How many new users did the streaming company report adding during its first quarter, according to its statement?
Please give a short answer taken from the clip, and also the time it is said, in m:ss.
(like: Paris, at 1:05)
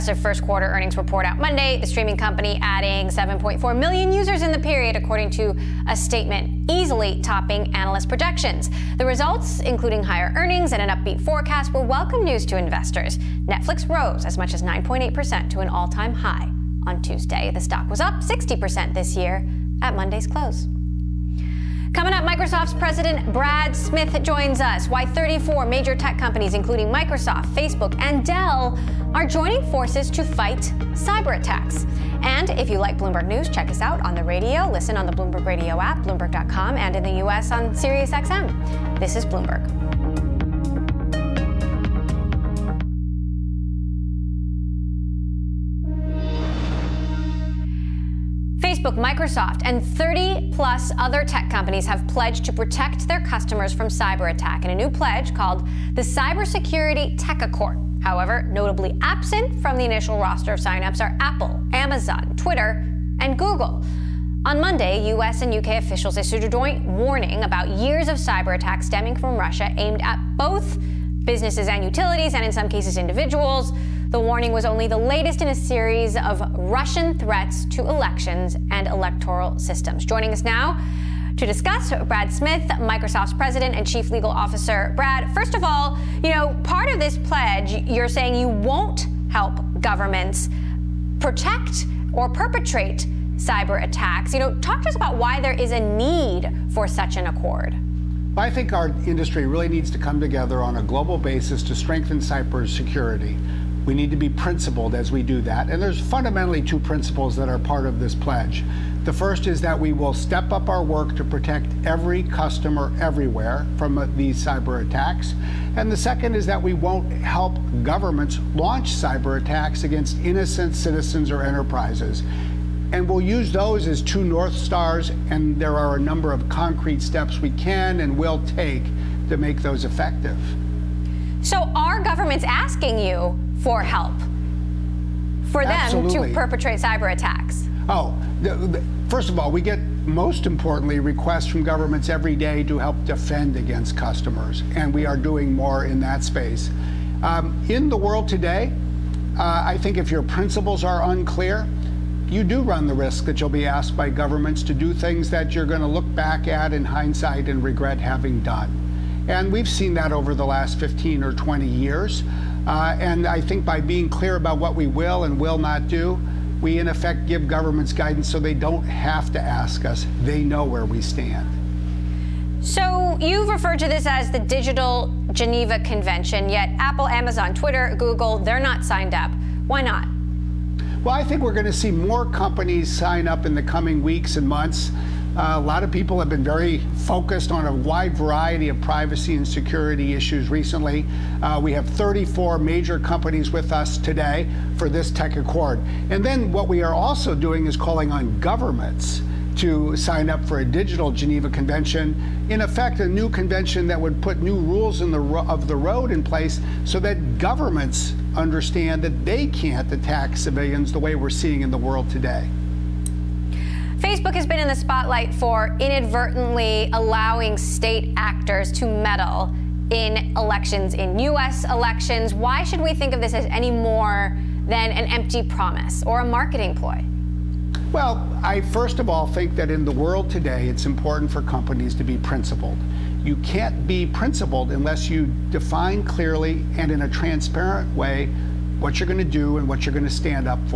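7.4 million, at 0:03.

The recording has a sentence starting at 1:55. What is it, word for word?
And the second is that we won't help governments launch cyber attacks against innocent citizens or enterprises.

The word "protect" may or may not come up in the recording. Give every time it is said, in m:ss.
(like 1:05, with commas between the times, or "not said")
0:52, 1:31, 1:51.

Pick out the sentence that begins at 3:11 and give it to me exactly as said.
Uh, we have 34 major companies with us today for this tech accord.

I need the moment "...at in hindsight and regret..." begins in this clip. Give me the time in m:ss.
2:36.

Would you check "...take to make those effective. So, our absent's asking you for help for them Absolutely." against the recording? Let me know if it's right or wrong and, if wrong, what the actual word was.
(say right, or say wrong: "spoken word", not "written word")
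wrong: "government", not "absent".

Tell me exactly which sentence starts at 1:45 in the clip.
And there's fundamentally two principles that are part of this pledge.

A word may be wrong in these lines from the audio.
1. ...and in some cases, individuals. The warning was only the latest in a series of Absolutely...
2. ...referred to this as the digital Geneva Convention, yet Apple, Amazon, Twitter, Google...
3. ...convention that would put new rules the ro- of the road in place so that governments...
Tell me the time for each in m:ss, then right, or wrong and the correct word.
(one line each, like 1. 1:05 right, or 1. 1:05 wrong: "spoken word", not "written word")
1. 1:12 wrong: "Russian", not "Absolutely"
2. 2:53 right
3. 3:23 right.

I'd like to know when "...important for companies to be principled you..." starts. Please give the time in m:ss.
3:50.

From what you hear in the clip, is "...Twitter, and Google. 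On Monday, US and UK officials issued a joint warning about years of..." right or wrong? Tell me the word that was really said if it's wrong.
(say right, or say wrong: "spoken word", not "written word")
right.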